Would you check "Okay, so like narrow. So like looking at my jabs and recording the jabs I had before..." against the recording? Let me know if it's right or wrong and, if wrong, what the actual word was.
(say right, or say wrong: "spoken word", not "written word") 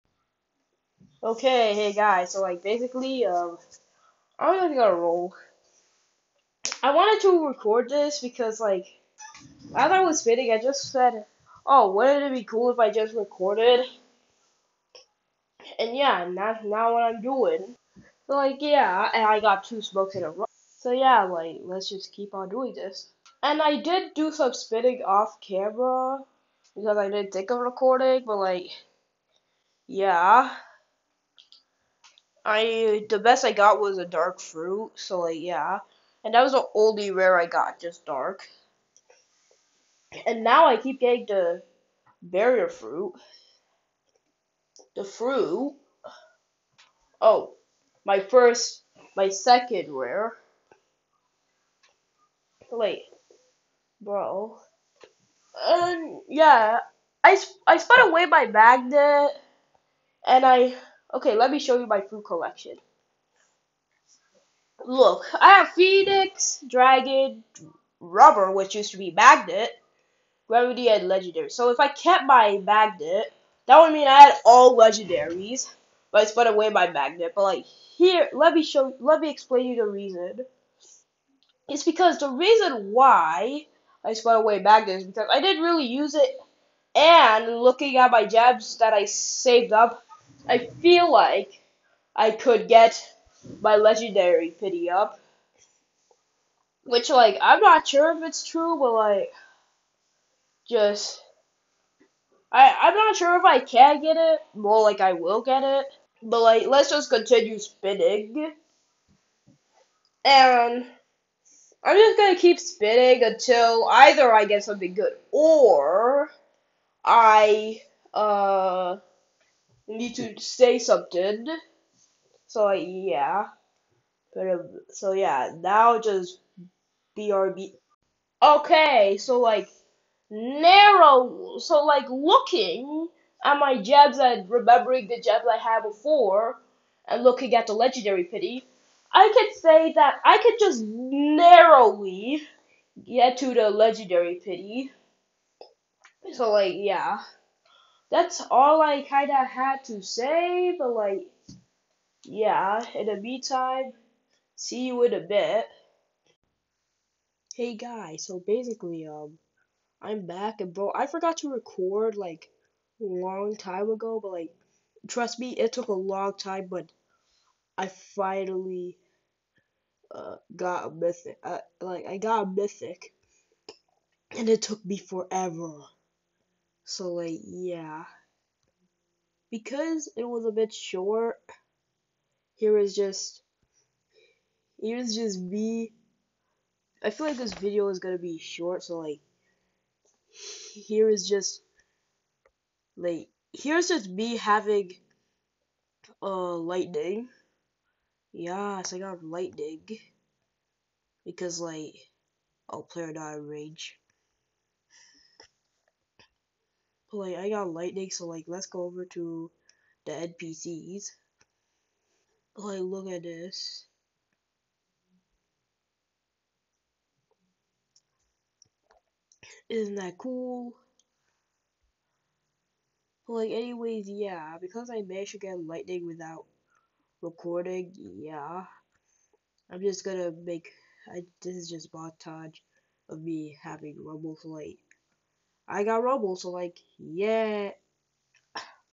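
wrong: "remembering", not "recording".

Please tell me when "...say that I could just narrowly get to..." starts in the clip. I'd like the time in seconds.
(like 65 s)
139 s.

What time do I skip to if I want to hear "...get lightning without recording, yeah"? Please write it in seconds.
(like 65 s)
225 s.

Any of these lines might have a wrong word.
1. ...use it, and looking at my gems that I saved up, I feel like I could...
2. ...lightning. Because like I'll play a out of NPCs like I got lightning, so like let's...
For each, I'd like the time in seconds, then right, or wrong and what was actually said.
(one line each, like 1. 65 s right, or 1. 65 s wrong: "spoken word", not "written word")
1. 85 s right
2. 199 s wrong: "But", not "NPCs".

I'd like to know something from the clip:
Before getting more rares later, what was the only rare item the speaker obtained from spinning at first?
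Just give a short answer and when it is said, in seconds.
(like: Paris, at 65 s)
dark fruit, at 34 s.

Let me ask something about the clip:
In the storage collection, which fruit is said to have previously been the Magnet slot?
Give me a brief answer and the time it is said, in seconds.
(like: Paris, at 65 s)
Rubber, at 67 s.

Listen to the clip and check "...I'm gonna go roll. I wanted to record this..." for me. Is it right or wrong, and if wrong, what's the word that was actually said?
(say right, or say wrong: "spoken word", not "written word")
right.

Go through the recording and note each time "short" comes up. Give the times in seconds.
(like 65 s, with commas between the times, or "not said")
180 s, 188 s.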